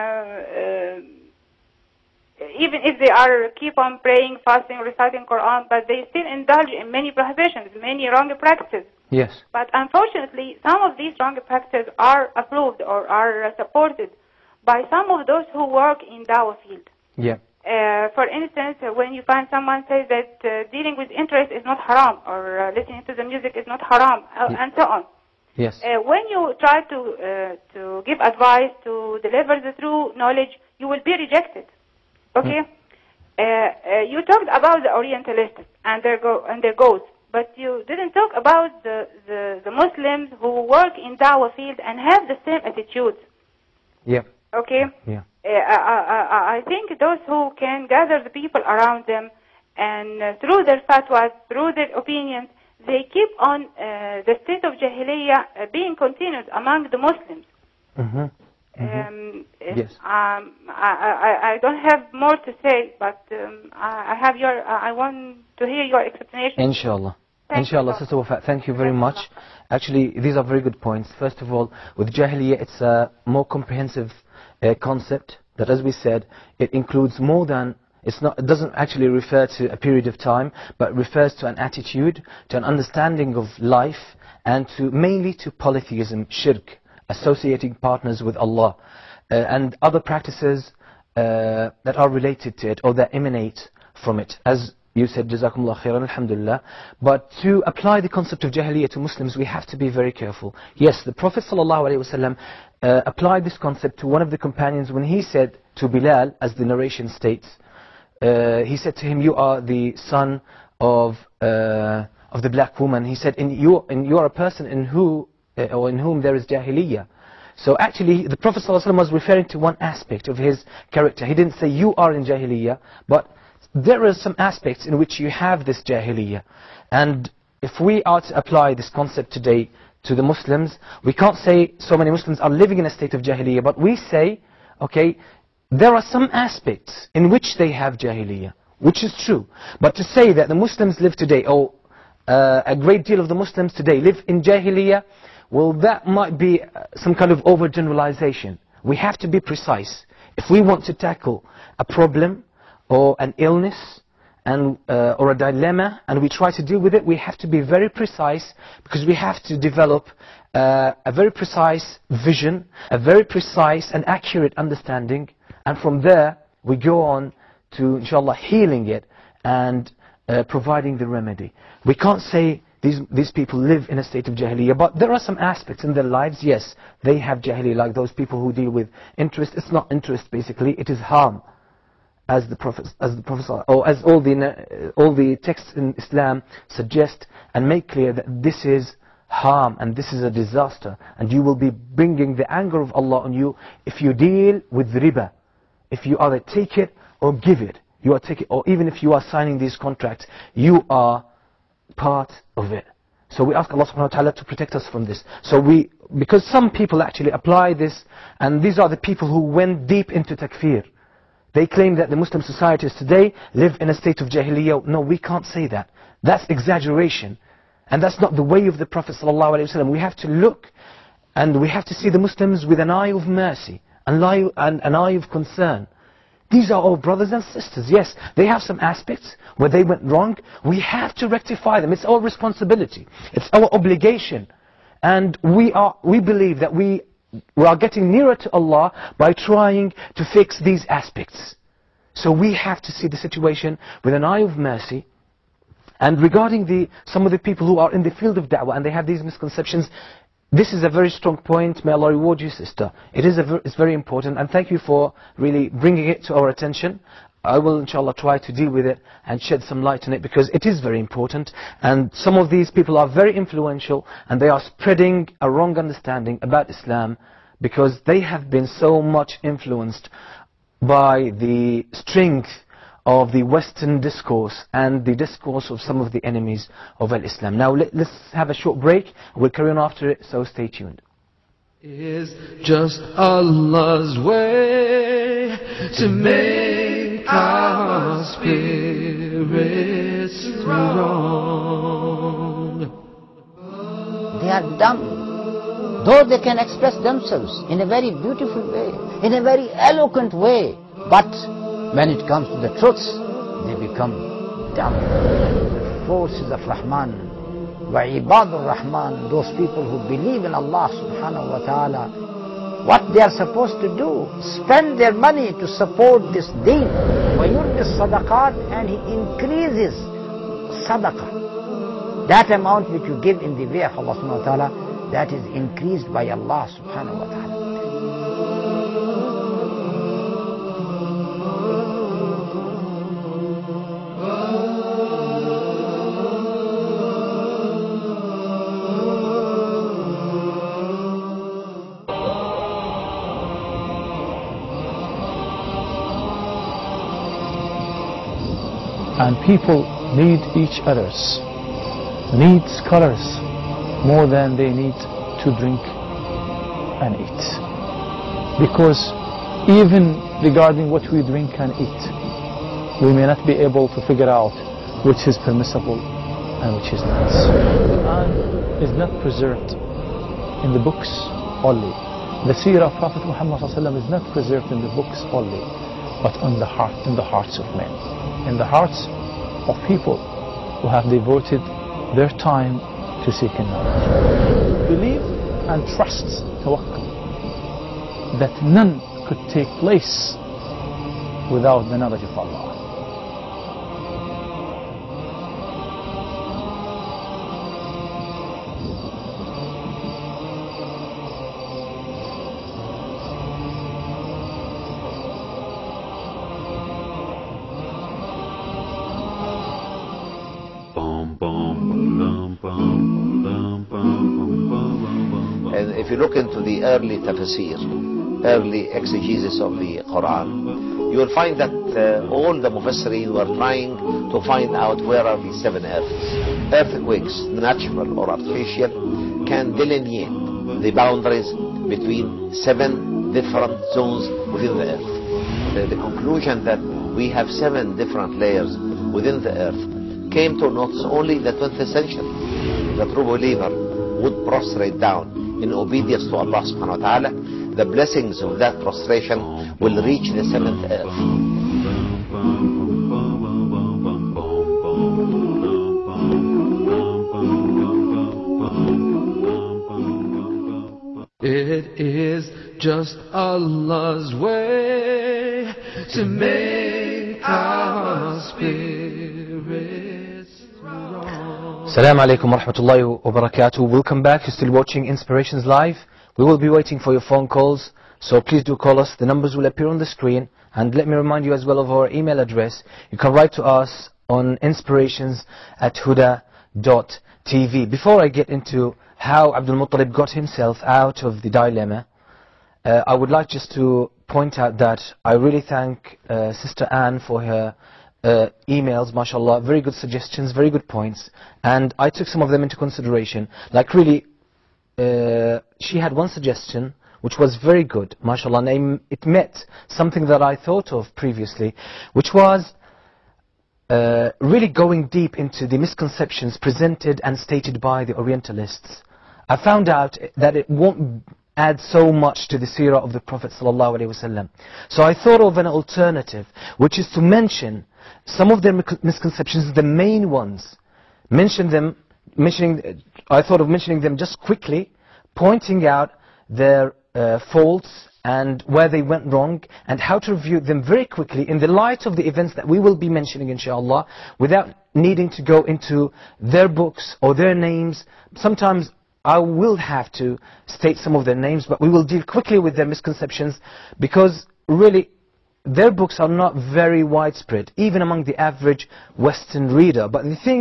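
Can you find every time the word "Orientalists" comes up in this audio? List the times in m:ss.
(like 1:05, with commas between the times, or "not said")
0:34, 8:38.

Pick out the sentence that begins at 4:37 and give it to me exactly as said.
Now, let's have a short break.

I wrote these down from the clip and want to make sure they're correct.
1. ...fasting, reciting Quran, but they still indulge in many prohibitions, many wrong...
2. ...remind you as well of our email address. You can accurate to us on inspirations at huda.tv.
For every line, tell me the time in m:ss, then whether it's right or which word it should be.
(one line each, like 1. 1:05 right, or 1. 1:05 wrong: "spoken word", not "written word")
1. 0:04 right
2. 8:01 wrong: "write", not "accurate".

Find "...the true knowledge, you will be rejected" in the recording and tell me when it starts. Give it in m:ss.
0:29.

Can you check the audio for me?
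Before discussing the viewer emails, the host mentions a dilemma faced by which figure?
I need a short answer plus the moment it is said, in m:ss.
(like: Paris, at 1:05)
Abdul Muttalib, at 8:09.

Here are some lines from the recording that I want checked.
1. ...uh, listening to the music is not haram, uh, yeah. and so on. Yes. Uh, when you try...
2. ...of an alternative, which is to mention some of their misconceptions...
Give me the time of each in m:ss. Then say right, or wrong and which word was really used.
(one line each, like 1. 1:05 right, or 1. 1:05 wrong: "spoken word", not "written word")
1. 0:22 right
2. 8:45 right.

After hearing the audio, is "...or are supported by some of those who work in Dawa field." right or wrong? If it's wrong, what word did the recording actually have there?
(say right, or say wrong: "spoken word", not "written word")
right.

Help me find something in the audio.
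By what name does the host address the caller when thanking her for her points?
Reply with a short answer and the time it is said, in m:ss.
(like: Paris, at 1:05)
Sister Wafa, at 1:07.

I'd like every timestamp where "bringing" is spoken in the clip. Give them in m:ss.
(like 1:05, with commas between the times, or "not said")
3:11, 4:15.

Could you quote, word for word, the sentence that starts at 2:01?
He didn't say, you are in jahiliyyah, but there are some aspects in which you have this jahiliyyah.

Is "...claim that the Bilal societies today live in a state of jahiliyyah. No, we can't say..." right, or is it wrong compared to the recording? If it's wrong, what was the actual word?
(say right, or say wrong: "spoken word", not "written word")
wrong: "Muslim", not "Bilal".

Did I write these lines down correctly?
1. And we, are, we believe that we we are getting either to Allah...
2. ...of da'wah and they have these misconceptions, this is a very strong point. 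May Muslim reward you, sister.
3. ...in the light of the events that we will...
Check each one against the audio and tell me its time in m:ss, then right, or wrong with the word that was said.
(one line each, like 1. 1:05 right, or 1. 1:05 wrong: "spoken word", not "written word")
1. 3:55 wrong: "nearer", not "either"
2. 4:08 wrong: "Allah", not "Muslim"
3. 9:01 right.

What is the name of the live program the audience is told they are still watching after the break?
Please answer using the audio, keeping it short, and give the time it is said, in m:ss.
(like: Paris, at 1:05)
Inspirations Live, at 7:55.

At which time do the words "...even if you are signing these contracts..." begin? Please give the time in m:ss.
3:18.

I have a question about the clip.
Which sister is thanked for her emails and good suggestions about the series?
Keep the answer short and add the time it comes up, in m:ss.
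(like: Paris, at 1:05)
Sister Anne, at 8:16.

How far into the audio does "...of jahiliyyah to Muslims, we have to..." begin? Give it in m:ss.
1:38.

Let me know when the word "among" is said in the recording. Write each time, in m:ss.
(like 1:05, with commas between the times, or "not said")
0:56, 9:18.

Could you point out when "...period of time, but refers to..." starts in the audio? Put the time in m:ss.
1:19.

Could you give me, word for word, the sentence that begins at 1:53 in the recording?
He said, in you, in you are a person in, who, uh, or in whom there is jahiliyyah.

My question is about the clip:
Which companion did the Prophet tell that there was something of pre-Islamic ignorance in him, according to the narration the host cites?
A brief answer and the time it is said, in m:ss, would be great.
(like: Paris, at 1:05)
Bilal, at 1:45.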